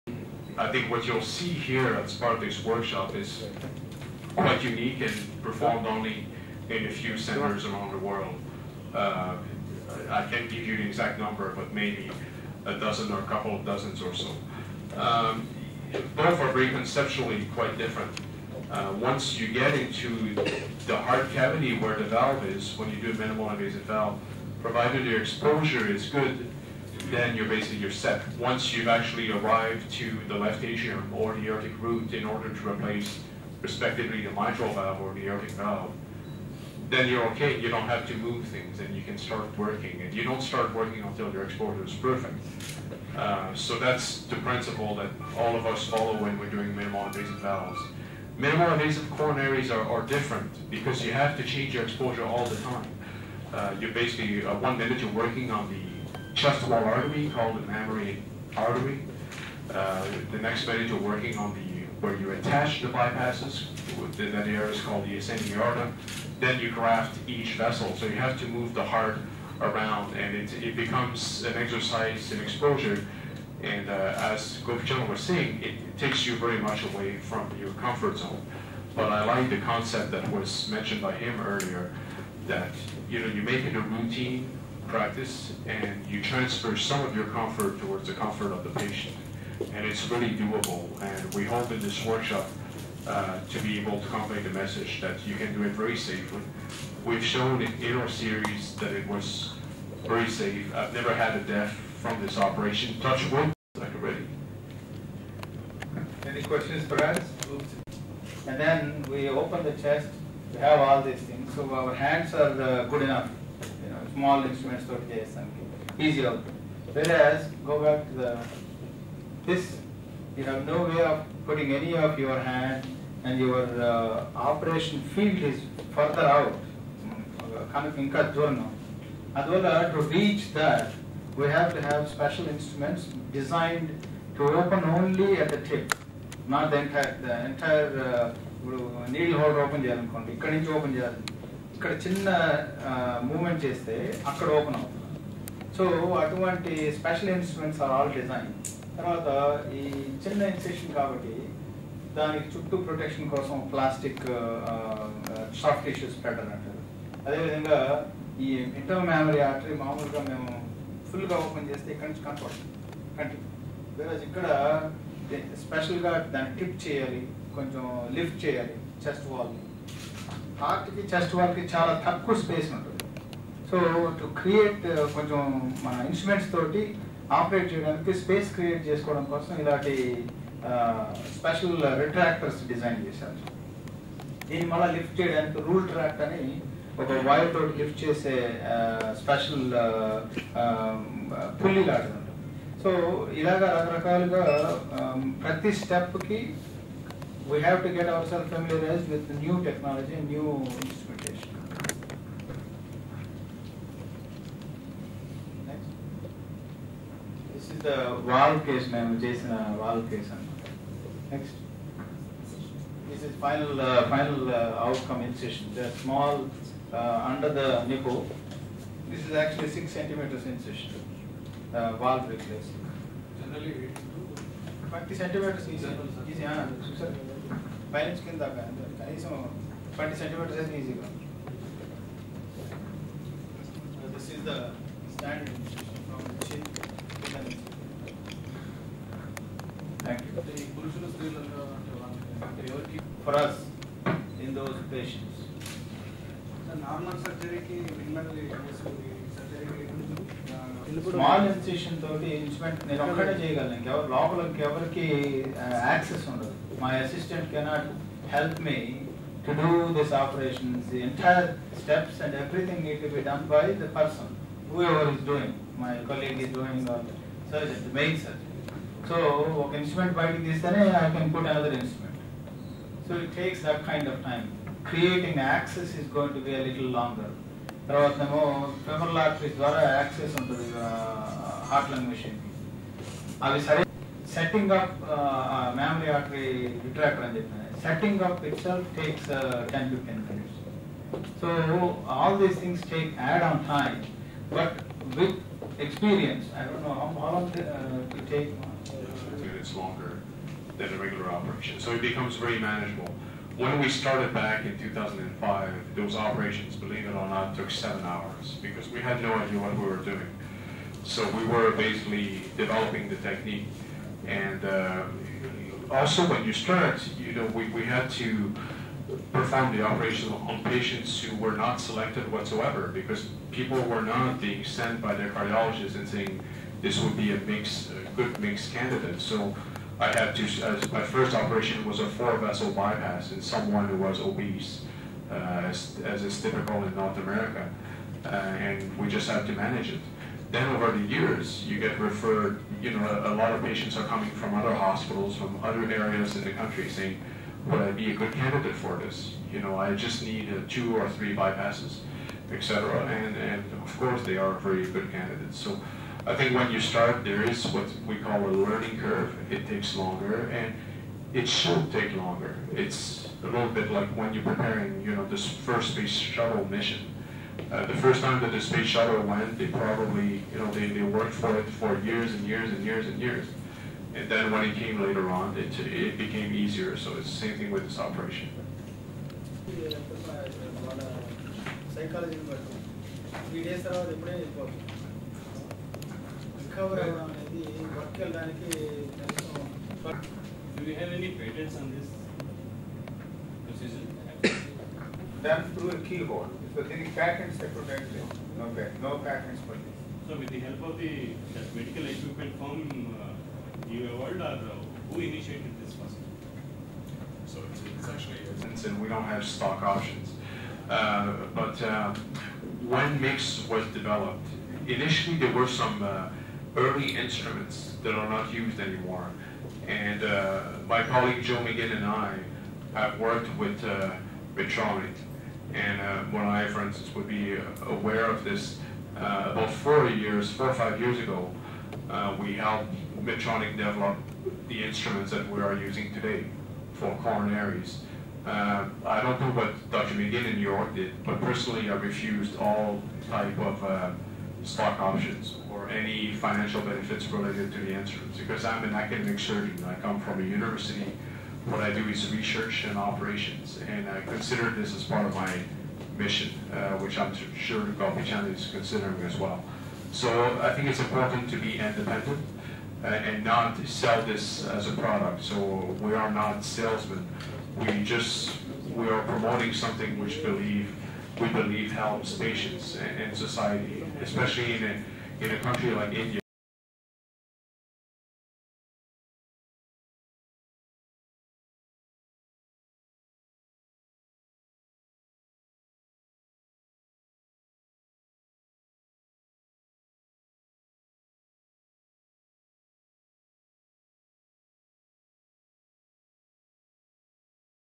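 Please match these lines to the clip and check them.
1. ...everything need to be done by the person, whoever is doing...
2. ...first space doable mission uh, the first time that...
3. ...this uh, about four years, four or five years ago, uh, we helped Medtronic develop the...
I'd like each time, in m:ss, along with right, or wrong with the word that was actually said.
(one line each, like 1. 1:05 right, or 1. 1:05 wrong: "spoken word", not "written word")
1. 4:22 right
2. 6:05 wrong: "shuttle", not "doable"
3. 7:08 right.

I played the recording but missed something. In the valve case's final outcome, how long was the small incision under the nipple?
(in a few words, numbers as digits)
6 centimeters.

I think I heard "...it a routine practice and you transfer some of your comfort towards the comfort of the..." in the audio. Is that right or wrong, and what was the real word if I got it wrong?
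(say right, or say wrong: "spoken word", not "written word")
right.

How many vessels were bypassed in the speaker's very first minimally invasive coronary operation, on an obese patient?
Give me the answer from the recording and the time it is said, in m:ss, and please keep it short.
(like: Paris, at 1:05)
4, at 5:32.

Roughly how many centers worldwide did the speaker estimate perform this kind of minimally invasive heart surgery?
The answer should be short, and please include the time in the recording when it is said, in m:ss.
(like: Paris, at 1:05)
a dozen or a couple of dozens, at 0:11.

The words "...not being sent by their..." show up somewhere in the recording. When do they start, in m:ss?
5:24.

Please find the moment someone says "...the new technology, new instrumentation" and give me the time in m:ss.
3:19.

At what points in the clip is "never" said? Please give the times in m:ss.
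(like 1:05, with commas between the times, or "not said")
1:40.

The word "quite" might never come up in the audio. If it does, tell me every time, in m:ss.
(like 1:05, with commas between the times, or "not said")
0:04, 0:17.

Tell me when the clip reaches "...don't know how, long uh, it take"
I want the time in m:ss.
4:56.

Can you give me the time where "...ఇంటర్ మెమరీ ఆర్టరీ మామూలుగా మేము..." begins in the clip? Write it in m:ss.
2:38.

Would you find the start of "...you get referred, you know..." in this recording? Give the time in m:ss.
5:41.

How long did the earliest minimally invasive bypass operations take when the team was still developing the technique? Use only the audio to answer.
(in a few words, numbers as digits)
7 hours.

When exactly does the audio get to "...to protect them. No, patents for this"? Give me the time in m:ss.
6:37.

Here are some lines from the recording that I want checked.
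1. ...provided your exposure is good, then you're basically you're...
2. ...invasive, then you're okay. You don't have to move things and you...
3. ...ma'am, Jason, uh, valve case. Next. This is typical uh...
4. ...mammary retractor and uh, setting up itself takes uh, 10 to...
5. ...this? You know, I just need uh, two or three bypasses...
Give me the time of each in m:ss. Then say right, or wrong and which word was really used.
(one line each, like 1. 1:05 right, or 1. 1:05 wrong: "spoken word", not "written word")
1. 0:24 right
2. 0:35 wrong: "valve", not "invasive"
3. 3:28 wrong: "final", not "typical"
4. 4:46 wrong: "artery", not "mammary"
5. 5:48 right.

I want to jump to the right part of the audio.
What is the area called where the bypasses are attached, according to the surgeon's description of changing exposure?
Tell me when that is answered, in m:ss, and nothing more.
1:05.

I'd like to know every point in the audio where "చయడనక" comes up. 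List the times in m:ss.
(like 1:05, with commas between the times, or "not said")
2:57, 3:05.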